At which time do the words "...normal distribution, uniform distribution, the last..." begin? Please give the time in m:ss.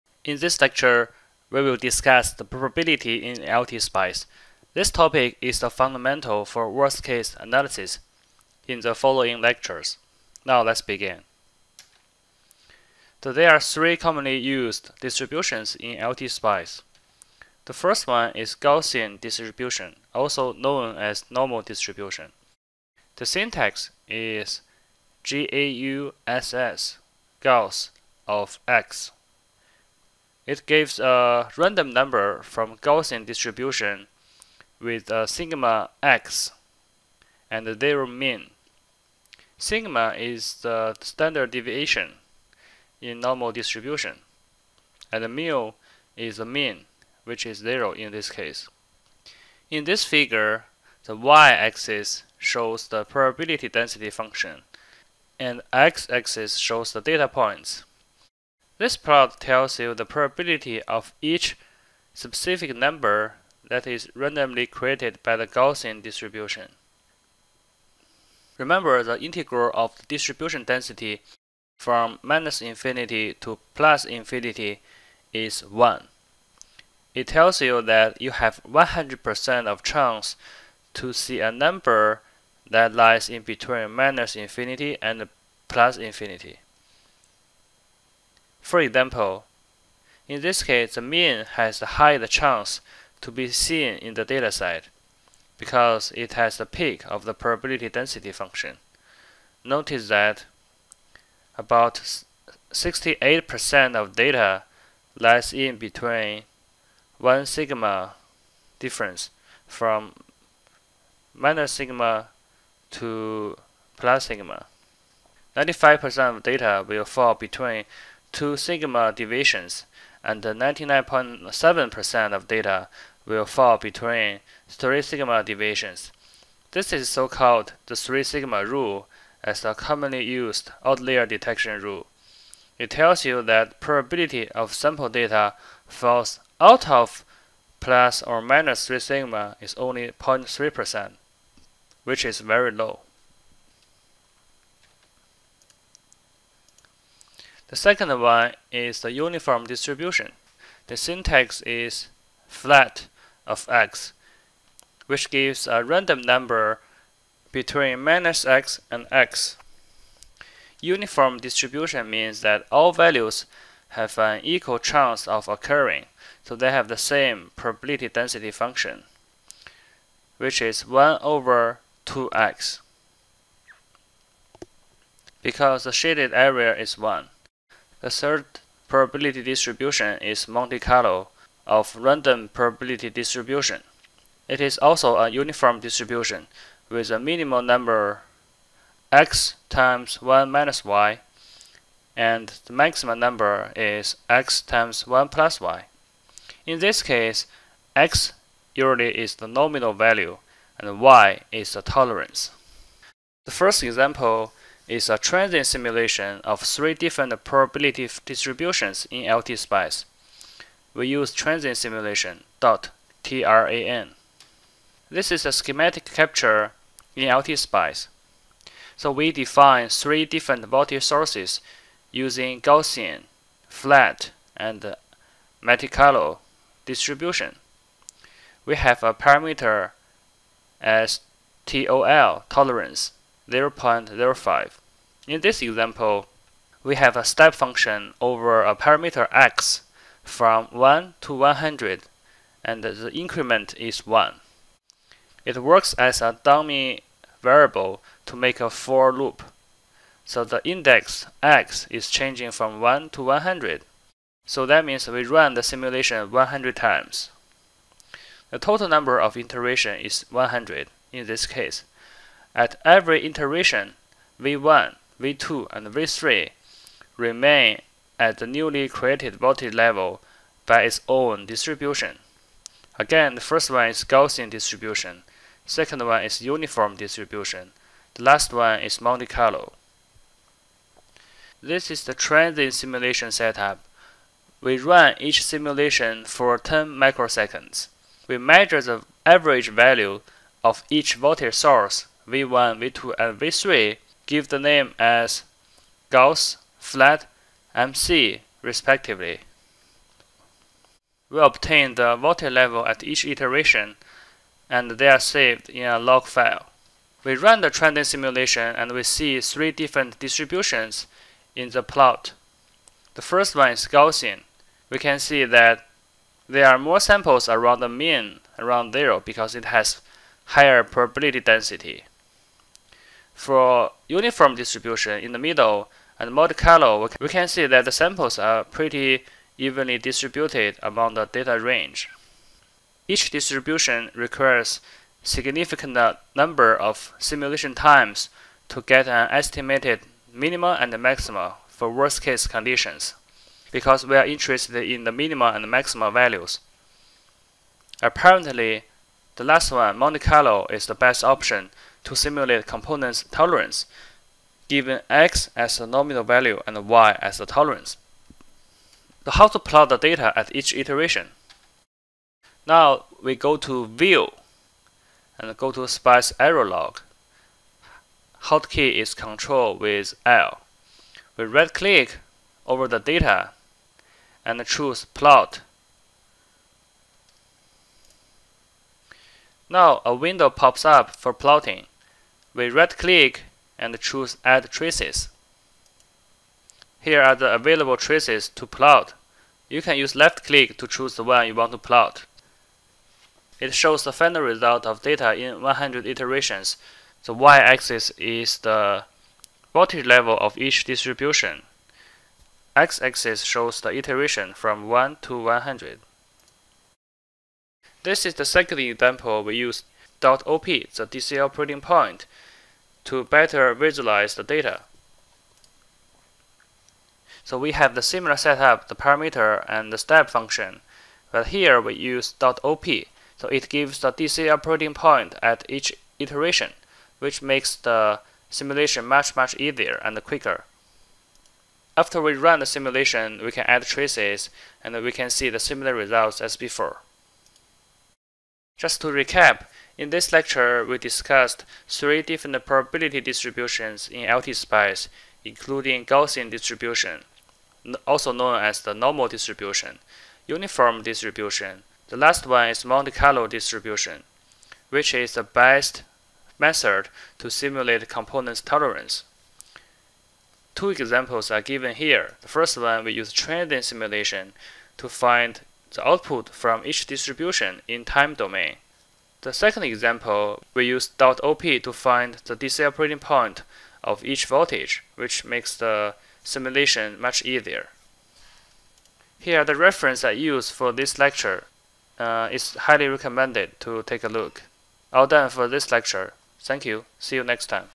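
7:28.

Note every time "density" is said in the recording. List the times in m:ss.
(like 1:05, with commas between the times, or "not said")
0:53, 1:10, 1:37, 2:48, 5:21.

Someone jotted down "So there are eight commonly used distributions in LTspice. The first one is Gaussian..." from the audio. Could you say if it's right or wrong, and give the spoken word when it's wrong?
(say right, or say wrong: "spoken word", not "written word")
wrong: "three", not "eight".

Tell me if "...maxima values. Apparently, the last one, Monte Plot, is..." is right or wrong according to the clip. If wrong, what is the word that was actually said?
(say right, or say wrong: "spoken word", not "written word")
wrong: "Carlo", not "Plot".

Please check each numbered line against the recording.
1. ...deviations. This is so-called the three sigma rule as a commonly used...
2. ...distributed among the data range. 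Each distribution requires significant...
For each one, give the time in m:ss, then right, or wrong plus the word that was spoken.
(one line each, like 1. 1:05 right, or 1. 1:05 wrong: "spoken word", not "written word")
1. 2:05 right
2. 5:29 right.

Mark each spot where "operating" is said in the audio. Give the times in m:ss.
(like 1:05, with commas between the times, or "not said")
6:51, 7:04, 7:52.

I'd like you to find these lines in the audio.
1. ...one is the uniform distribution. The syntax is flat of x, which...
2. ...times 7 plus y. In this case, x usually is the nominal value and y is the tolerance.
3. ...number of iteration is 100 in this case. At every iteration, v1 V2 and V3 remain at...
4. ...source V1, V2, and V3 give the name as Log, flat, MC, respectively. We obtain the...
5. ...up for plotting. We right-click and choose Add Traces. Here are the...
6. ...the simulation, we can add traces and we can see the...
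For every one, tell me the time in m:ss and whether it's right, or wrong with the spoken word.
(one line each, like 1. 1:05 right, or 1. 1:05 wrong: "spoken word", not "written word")
1. 2:28 right
2. 3:14 wrong: "1", not "7"
3. 4:18 right
4. 4:51 wrong: "Gauss", not "Log"
5. 6:20 right
6. 7:12 right.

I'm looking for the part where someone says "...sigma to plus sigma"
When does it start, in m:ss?
1:51.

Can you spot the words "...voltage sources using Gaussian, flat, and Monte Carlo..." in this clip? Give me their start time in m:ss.
3:40.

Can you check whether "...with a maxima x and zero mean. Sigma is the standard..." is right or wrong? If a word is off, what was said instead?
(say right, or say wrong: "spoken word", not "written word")
wrong: "sigma", not "maxima".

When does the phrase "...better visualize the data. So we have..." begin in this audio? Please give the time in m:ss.
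6:53.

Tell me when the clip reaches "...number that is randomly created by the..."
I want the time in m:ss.
1:02.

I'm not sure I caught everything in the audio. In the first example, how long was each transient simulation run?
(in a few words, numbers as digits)
10 microseconds.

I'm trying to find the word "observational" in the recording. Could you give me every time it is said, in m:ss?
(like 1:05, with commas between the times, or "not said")
not said.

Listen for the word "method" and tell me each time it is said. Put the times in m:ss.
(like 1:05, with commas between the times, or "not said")
7:36.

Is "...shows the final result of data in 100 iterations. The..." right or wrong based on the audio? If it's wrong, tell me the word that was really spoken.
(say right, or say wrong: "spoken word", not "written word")
right.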